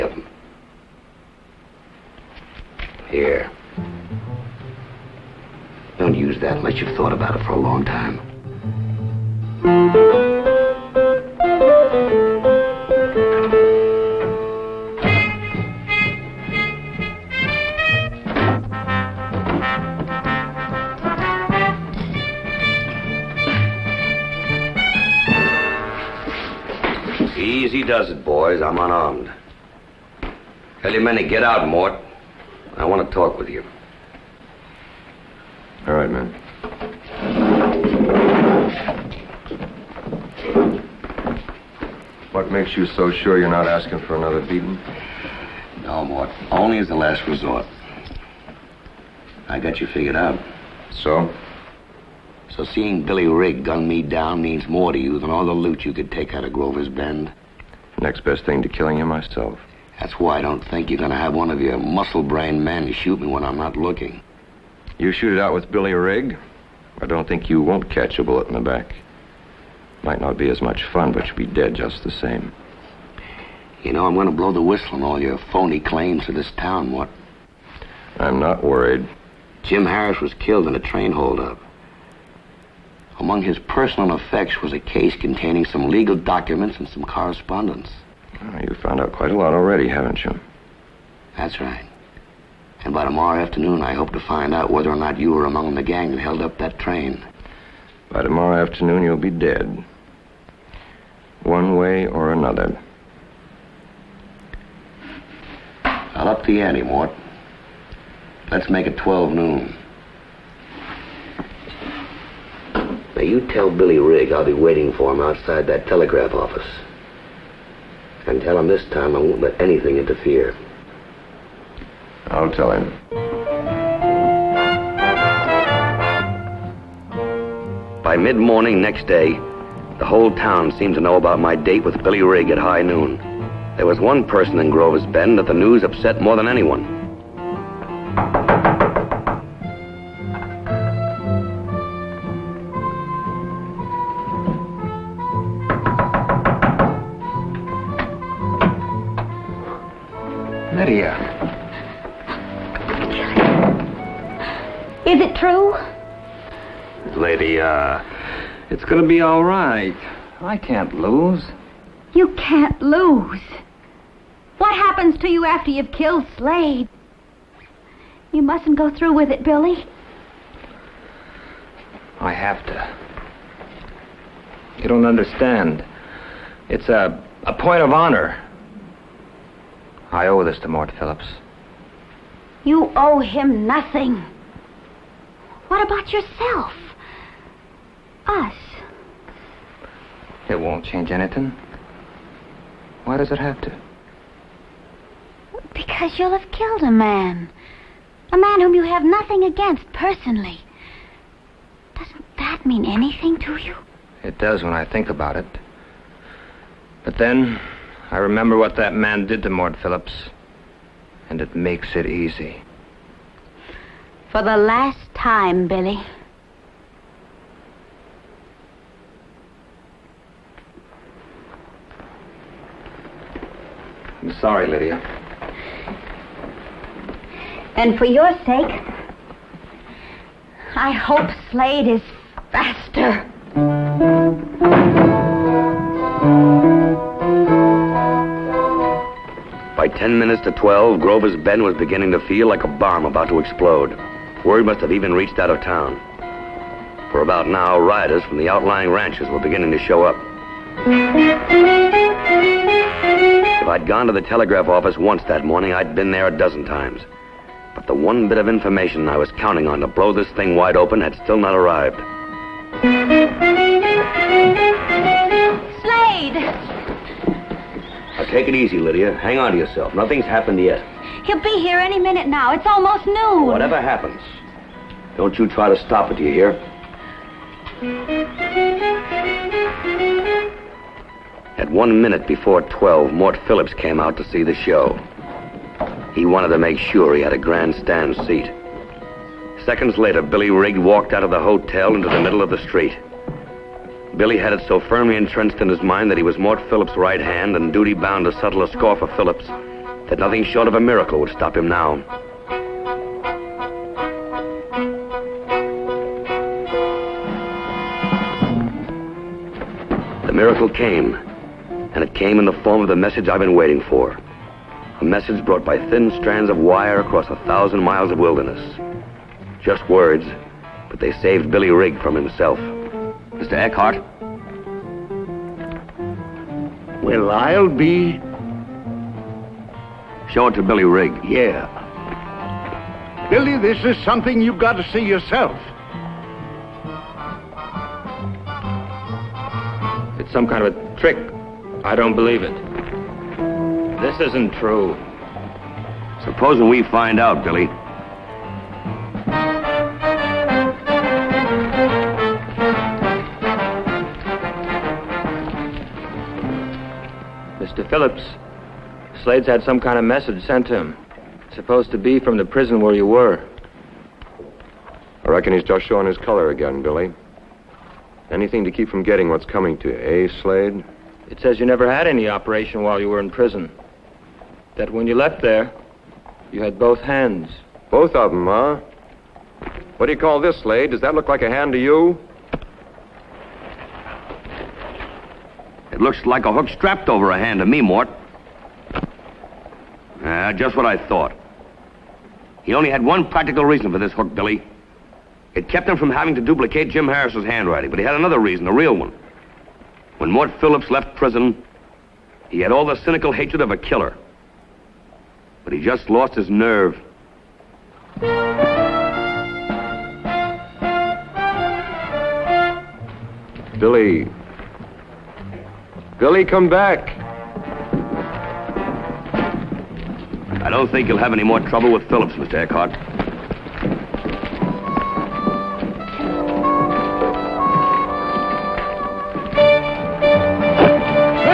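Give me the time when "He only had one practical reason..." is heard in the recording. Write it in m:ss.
6:32.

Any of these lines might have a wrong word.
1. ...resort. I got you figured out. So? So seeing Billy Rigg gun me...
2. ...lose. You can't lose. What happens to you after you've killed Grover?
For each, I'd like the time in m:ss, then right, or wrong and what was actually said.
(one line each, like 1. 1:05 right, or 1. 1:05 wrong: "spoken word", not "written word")
1. 0:47 right
2. 2:40 wrong: "Slade", not "Grover".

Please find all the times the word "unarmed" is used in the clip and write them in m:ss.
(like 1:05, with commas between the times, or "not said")
0:28.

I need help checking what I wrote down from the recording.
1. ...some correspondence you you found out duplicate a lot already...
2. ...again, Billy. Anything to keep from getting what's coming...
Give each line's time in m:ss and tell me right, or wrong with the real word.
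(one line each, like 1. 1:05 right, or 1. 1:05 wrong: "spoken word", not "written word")
1. 1:26 wrong: "quite", not "duplicate"
2. 6:06 right.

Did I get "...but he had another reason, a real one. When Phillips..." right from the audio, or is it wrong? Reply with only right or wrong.
wrong.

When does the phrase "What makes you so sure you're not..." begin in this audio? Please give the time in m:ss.
0:42.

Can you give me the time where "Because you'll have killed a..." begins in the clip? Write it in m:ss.
3:15.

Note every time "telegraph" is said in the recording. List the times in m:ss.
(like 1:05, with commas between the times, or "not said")
1:55, 4:14.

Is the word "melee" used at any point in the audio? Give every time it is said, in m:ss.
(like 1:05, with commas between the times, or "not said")
not said.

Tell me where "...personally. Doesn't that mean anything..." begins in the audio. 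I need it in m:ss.
3:19.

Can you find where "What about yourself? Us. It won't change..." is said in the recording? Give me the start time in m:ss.
3:05.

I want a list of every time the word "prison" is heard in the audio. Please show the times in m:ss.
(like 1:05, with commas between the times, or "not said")
6:02, 6:13, 6:41.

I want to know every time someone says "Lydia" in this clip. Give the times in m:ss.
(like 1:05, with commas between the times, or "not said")
3:44, 4:28.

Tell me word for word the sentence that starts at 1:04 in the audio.
You shoot it out with Billy Rigg?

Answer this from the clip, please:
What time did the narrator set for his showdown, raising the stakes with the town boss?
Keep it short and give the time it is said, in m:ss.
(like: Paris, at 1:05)
12 noon, at 1:48.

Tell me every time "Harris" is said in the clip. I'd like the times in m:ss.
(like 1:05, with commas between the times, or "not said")
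1:19, 6:37.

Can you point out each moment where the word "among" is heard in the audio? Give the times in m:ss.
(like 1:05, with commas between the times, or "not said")
1:23, 1:35.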